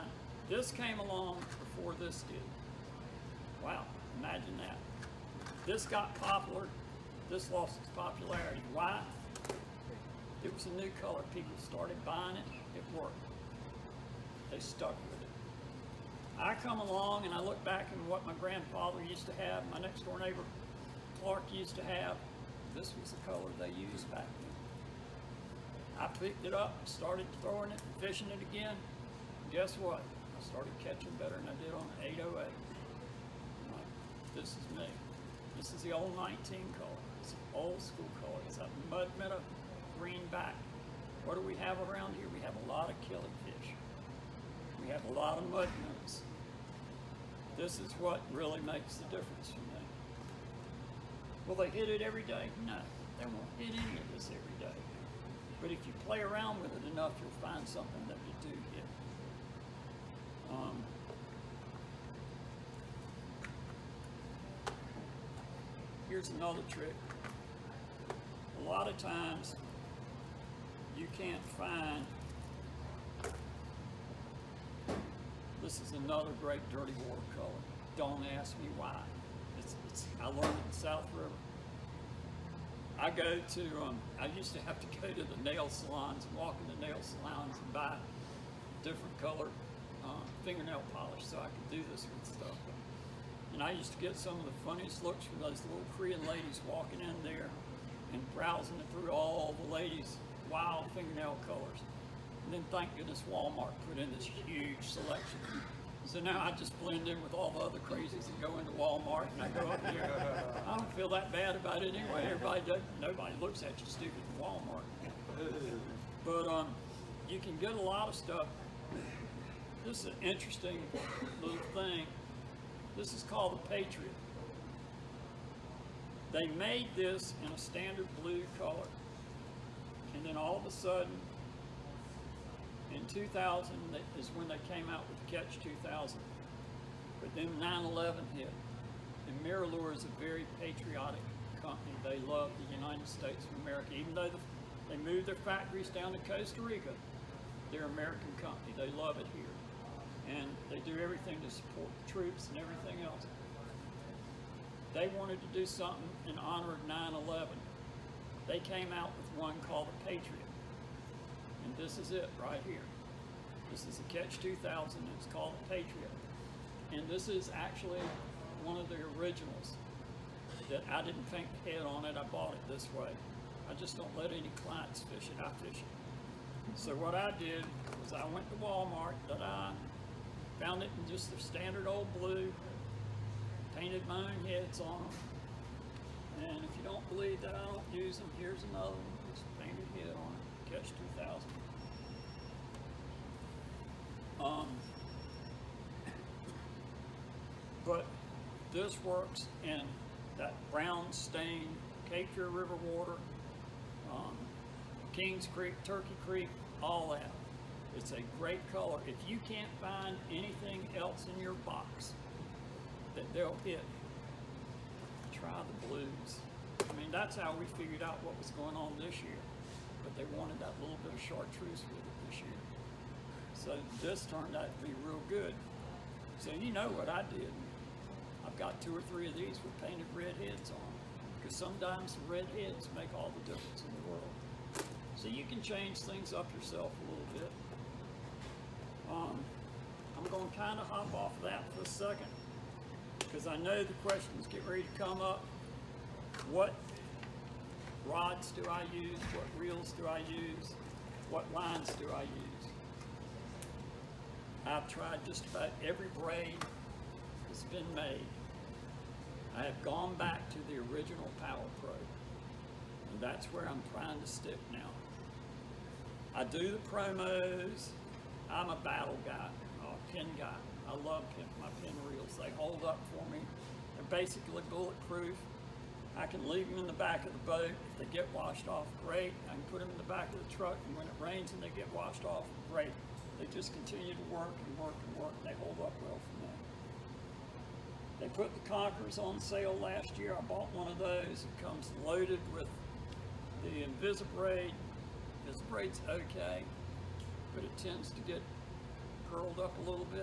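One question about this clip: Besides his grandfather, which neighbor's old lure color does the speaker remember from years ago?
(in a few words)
Clark.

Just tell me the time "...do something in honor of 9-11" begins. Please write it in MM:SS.
02:35.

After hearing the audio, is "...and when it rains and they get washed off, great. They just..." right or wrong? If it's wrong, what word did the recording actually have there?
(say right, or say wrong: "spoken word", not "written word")
right.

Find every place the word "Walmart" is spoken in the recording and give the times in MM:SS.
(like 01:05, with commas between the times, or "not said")
01:43, 01:48, 01:54, 02:58.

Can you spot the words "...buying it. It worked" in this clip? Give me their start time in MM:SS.
00:12.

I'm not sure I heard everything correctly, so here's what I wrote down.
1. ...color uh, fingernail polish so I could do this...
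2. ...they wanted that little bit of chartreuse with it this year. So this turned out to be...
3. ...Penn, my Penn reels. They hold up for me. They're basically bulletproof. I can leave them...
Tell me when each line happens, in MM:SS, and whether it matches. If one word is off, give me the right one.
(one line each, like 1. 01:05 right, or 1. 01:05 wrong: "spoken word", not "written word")
1. 01:29 right
2. 03:40 right
3. 04:31 right.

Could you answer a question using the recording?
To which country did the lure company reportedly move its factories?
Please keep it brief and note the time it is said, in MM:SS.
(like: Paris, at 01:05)
Costa Rica, at 02:26.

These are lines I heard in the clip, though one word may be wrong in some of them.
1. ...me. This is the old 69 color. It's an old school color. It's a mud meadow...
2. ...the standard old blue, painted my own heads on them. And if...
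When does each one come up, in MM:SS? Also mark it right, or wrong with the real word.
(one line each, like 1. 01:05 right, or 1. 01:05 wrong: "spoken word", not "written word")
1. 00:34 wrong: "19", not "69"
2. 03:01 right.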